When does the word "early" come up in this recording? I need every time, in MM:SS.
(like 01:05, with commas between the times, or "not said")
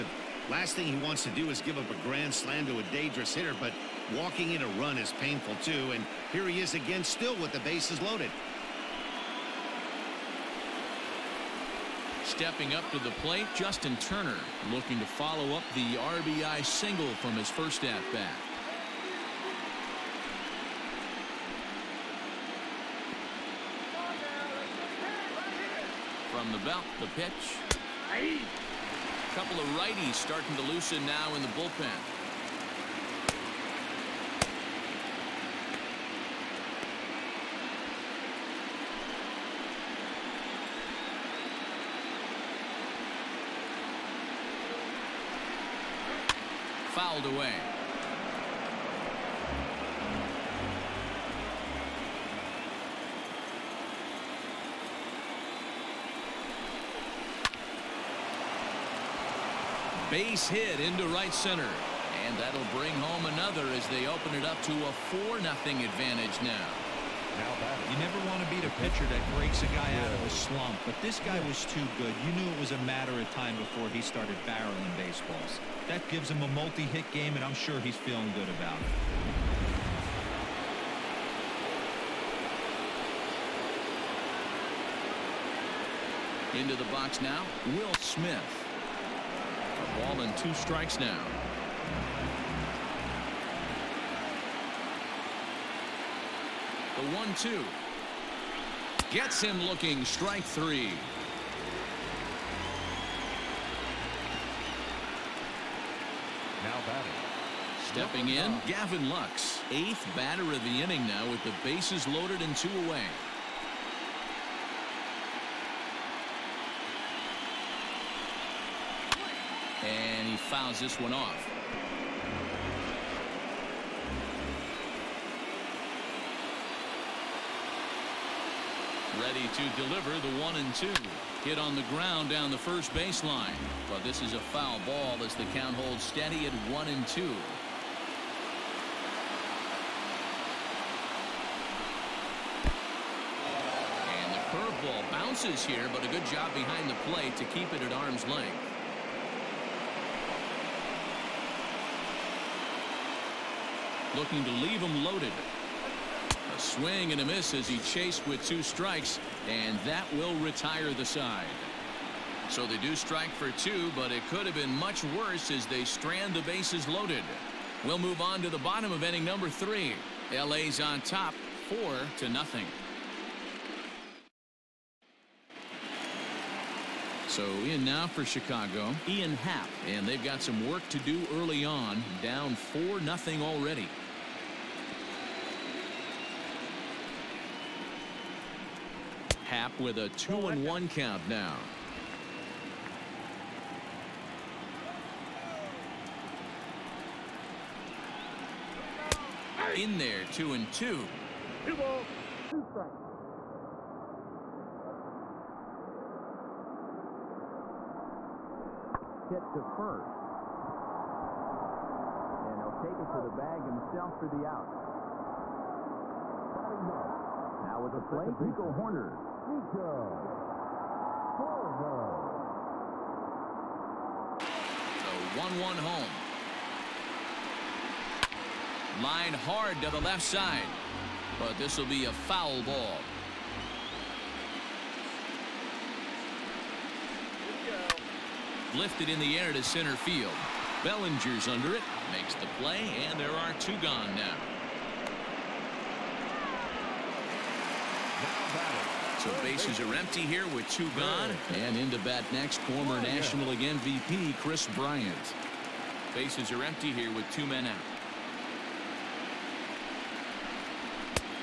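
03:01.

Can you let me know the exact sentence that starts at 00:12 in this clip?
Stepping up to the plate, Justin Turner looking to follow up the RBI single from his first at bat.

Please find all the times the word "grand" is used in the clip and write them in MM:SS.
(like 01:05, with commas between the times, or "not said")
00:02.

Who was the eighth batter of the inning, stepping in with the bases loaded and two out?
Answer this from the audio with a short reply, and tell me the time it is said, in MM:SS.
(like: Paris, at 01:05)
Gavin Lux, at 01:48.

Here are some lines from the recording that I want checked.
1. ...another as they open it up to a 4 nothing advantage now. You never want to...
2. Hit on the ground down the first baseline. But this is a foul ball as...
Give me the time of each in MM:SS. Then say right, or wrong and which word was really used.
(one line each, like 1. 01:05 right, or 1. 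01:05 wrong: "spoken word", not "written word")
1. 01:03 right
2. 02:11 right.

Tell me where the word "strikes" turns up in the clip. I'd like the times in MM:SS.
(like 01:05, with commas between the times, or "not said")
01:30, 01:40, 02:38, 02:42, 03:22.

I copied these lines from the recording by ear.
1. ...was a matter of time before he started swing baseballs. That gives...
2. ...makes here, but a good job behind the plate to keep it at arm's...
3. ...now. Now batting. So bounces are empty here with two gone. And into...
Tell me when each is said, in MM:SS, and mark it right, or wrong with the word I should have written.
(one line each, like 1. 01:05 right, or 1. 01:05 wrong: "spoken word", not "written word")
1. 01:12 wrong: "barreling", not "swing"
2. 02:25 wrong: "bounces", not "makes"
3. 04:04 wrong: "bases", not "bounces".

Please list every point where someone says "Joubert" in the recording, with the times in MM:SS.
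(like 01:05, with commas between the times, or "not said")
not said.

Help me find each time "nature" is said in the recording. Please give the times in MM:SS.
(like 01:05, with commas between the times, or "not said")
not said.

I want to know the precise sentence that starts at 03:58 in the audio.
Lifted in the air to center field.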